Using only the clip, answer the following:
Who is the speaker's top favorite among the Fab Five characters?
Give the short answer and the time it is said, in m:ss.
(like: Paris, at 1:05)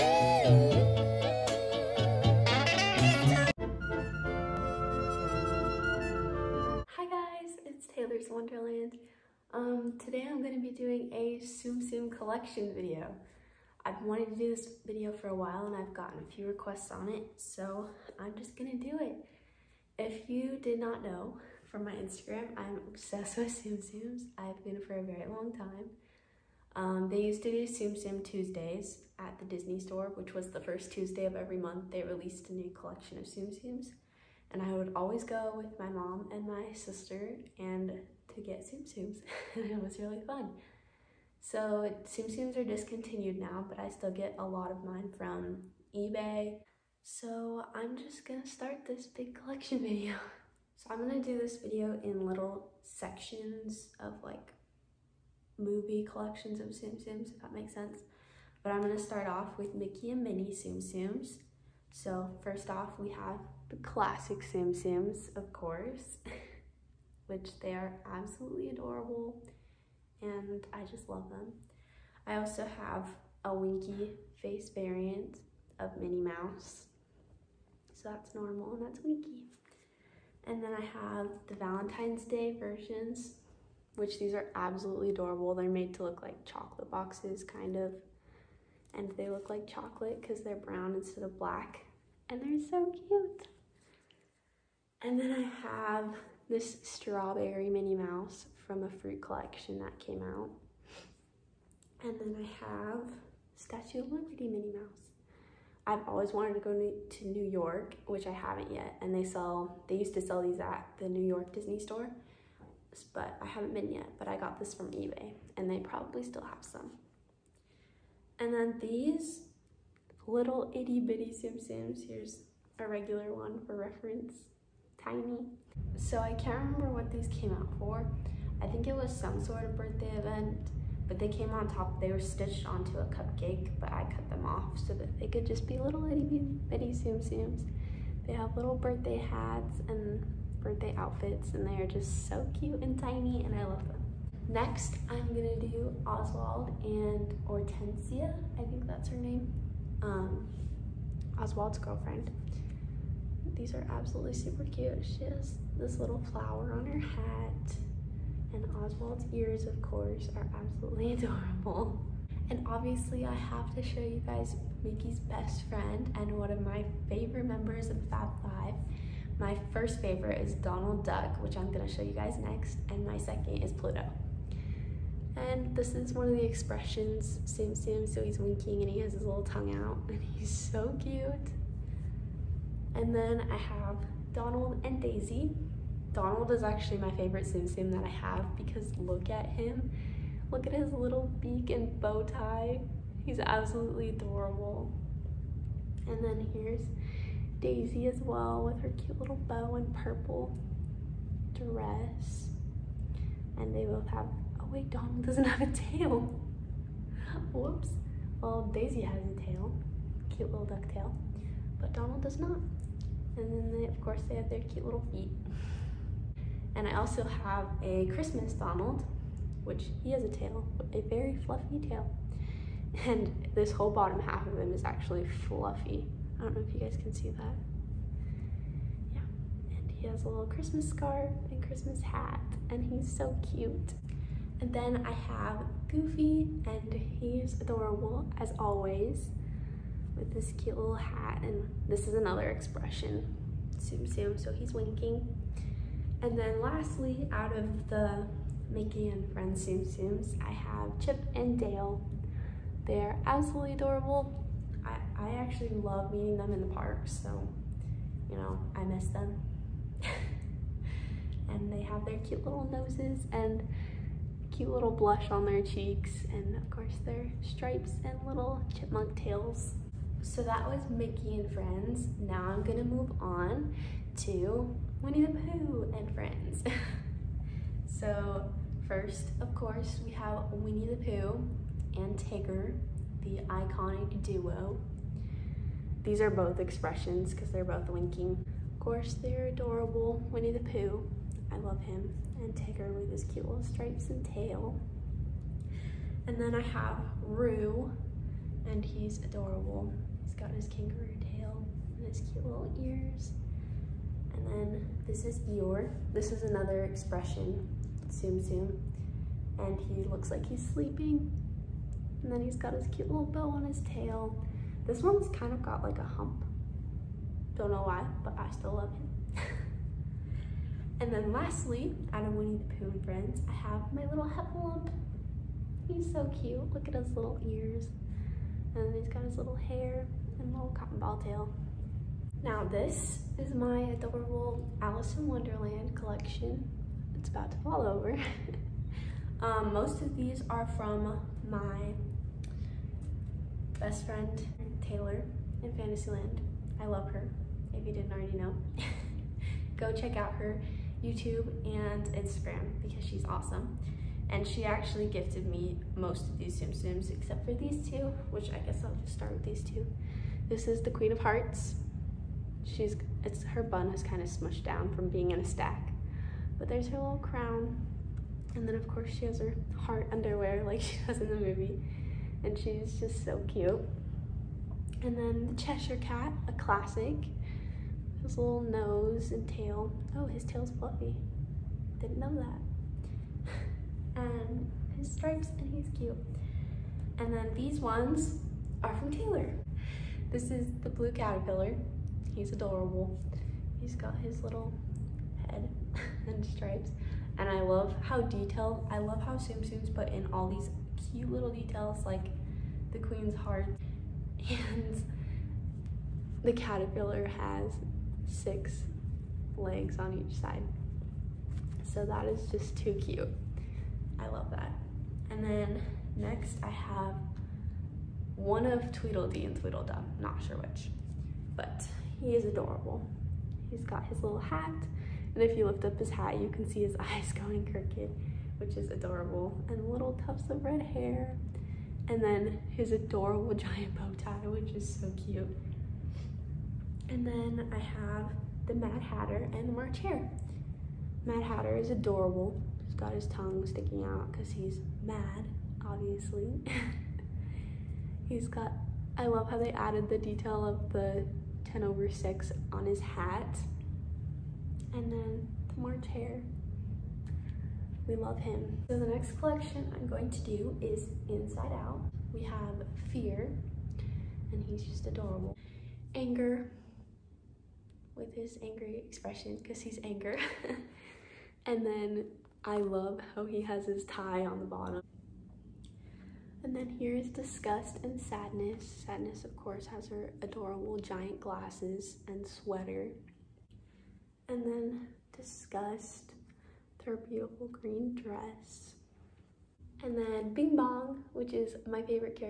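Donald Duck, at 2:50.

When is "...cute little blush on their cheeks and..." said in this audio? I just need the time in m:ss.
4:24.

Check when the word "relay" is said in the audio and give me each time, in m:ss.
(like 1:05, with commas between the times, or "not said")
not said.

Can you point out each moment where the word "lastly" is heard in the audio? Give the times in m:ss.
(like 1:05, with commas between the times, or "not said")
4:06, 5:21.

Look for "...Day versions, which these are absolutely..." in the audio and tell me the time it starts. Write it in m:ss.
1:22.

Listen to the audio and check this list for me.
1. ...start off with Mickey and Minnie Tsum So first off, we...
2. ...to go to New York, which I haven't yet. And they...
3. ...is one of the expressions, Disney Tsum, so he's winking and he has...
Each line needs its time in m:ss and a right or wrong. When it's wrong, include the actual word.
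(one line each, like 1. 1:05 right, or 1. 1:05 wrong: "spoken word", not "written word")
1. 0:58 right
2. 1:46 right
3. 2:55 wrong: "Tsum", not "Disney".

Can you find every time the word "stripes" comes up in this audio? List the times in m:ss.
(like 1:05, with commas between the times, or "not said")
4:27, 4:53, 6:25, 6:36.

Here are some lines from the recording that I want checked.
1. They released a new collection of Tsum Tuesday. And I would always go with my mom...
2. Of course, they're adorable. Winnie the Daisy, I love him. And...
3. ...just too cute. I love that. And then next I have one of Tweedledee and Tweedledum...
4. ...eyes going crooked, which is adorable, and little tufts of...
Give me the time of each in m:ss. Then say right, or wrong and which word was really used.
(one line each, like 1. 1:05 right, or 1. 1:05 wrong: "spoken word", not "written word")
1. 0:31 wrong: "Tsums", not "Tuesday"
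2. 4:48 wrong: "Pooh", not "Daisy"
3. 6:52 right
4. 7:06 right.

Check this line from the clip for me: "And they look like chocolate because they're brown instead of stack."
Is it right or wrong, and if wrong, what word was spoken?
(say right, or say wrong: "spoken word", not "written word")
wrong: "black", not "stack".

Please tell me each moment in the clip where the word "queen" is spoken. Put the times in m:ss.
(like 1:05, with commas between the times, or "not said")
6:00, 6:42.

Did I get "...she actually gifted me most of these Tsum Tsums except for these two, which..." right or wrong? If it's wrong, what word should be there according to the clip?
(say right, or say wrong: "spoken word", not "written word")
right.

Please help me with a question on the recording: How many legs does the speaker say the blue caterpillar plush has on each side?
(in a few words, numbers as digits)
6.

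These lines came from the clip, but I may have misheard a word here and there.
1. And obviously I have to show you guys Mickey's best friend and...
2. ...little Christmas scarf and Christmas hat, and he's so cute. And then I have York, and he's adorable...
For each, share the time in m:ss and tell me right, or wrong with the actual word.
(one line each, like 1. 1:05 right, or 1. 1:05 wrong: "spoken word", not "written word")
1. 2:42 right
2. 3:50 wrong: "Goofy", not "York".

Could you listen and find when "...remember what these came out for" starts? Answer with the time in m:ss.
2:06.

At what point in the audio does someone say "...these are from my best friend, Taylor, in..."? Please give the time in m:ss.
5:40.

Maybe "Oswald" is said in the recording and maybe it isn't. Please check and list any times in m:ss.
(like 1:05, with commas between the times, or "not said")
2:26, 2:31, 2:38.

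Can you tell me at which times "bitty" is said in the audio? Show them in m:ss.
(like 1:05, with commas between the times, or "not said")
2:00, 2:16.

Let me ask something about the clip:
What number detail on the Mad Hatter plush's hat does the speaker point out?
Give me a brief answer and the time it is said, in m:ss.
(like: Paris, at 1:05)
10 over 6, at 7:31.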